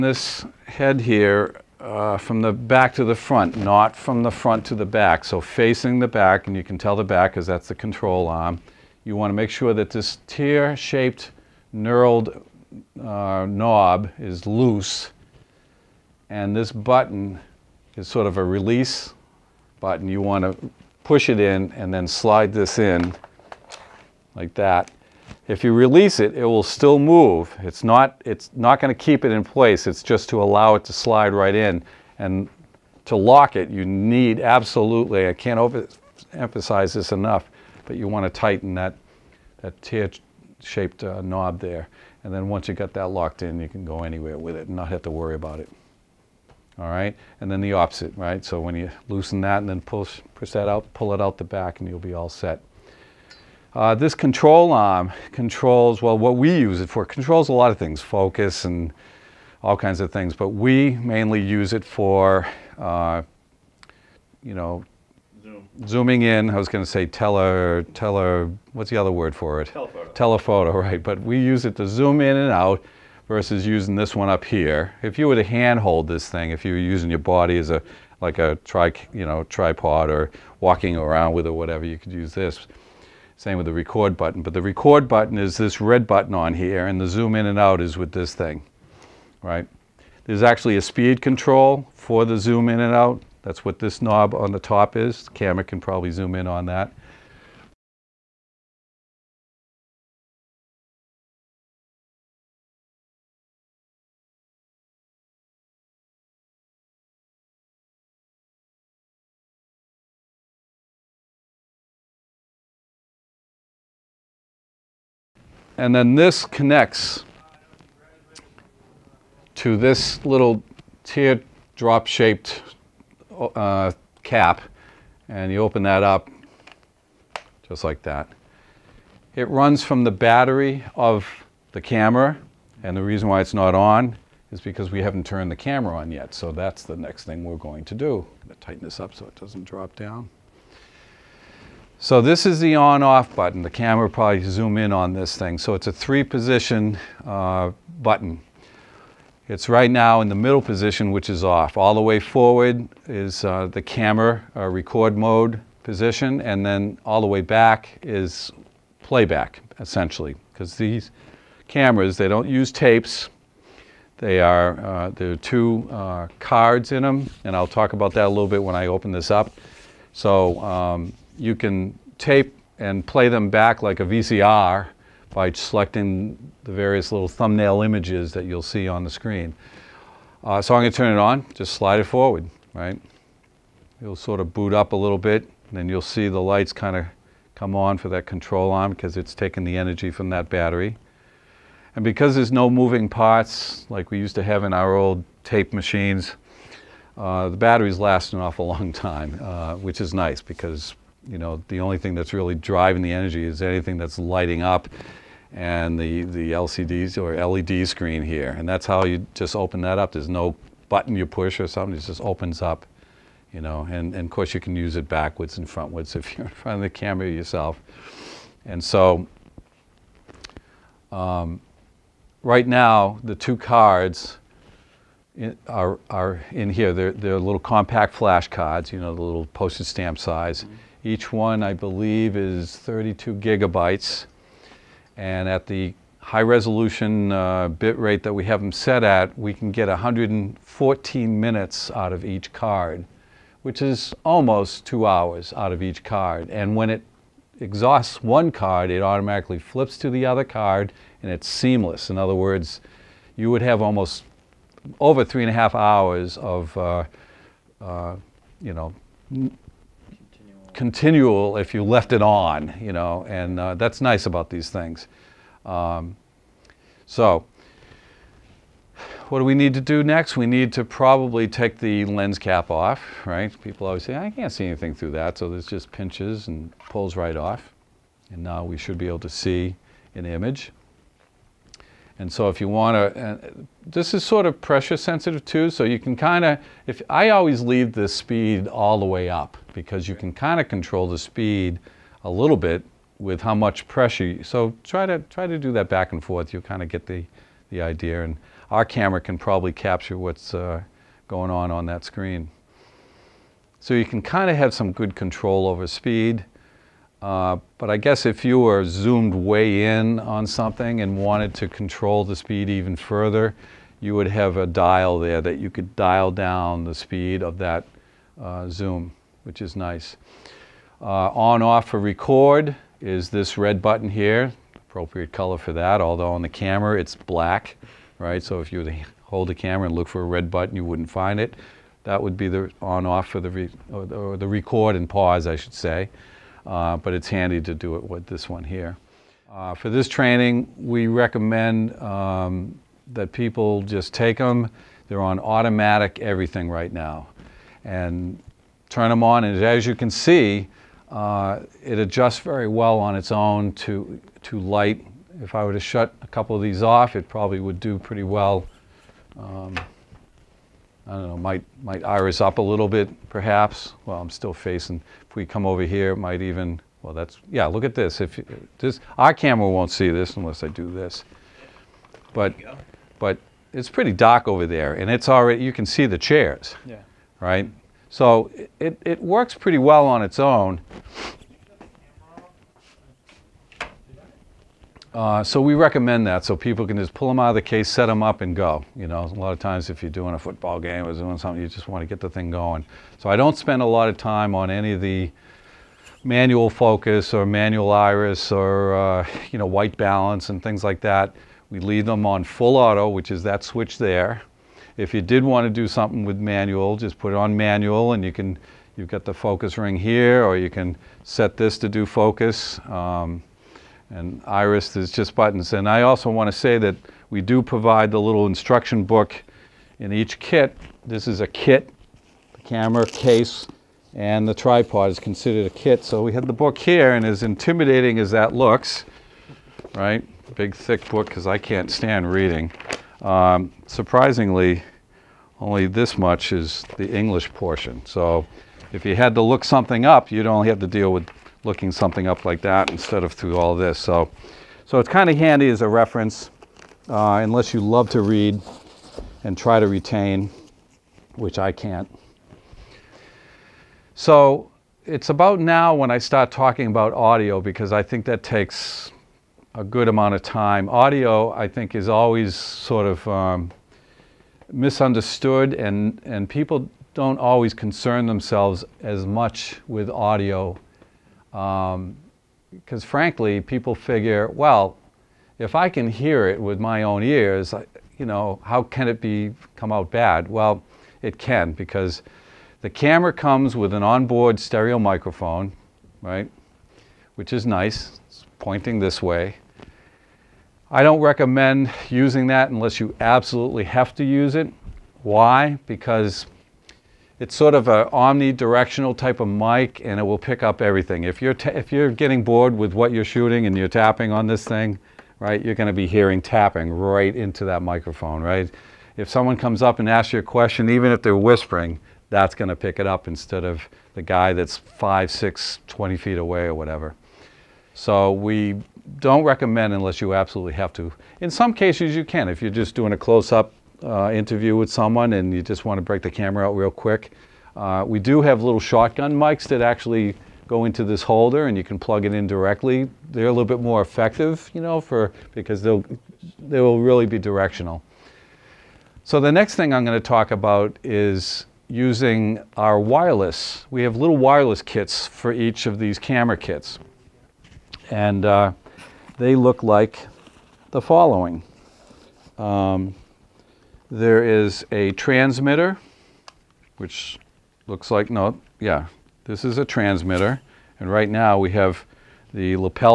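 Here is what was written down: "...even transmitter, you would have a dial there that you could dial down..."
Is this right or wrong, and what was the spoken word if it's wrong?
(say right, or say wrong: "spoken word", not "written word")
wrong: "further", not "transmitter".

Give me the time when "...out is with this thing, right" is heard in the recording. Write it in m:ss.
1:27.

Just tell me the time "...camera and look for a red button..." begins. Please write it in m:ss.
5:29.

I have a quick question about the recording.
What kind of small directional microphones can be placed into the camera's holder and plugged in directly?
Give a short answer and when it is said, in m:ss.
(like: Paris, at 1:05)
Shotgun mics, at 8:48.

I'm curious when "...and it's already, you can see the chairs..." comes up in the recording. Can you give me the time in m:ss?
6:14.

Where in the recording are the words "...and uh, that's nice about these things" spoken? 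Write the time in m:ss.
4:23.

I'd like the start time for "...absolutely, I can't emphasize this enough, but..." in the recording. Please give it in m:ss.
0:34.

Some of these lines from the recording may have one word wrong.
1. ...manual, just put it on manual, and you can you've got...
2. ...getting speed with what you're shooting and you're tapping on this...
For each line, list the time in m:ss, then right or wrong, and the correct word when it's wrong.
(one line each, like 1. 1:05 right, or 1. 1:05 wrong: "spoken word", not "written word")
1. 6:46 right
2. 8:22 wrong: "bored", not "speed".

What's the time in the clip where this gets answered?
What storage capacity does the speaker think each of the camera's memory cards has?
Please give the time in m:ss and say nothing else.
3:52.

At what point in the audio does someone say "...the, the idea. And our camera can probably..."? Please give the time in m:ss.
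4:57.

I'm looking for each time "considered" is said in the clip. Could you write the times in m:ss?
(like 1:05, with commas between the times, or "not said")
7:05.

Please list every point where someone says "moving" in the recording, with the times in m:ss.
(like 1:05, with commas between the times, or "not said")
3:12.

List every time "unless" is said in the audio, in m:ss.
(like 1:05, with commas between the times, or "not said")
6:10, 7:27, 8:12, 8:39.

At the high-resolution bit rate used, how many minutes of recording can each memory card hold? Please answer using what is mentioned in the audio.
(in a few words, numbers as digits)
114.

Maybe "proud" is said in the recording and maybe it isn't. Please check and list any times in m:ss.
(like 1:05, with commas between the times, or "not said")
not said.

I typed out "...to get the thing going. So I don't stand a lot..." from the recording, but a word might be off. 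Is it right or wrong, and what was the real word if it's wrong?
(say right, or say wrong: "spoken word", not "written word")
wrong: "spend", not "stand".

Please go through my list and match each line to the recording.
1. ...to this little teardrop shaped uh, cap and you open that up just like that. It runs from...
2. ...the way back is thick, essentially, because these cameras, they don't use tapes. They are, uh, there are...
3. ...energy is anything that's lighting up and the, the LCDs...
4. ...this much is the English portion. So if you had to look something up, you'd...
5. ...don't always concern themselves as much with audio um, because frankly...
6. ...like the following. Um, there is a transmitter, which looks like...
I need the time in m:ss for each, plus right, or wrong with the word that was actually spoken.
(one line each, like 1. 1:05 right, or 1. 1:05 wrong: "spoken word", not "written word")
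1. 1:59 right
2. 2:37 wrong: "playback", not "thick"
3. 3:23 right
4. 7:15 right
5. 7:47 right
6. 9:09 right.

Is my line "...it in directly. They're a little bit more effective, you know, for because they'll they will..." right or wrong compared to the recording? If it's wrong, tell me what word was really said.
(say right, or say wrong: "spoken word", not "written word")
right.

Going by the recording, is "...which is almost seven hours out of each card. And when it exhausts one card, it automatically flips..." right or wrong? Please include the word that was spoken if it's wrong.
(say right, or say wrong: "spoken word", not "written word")
wrong: "two", not "seven".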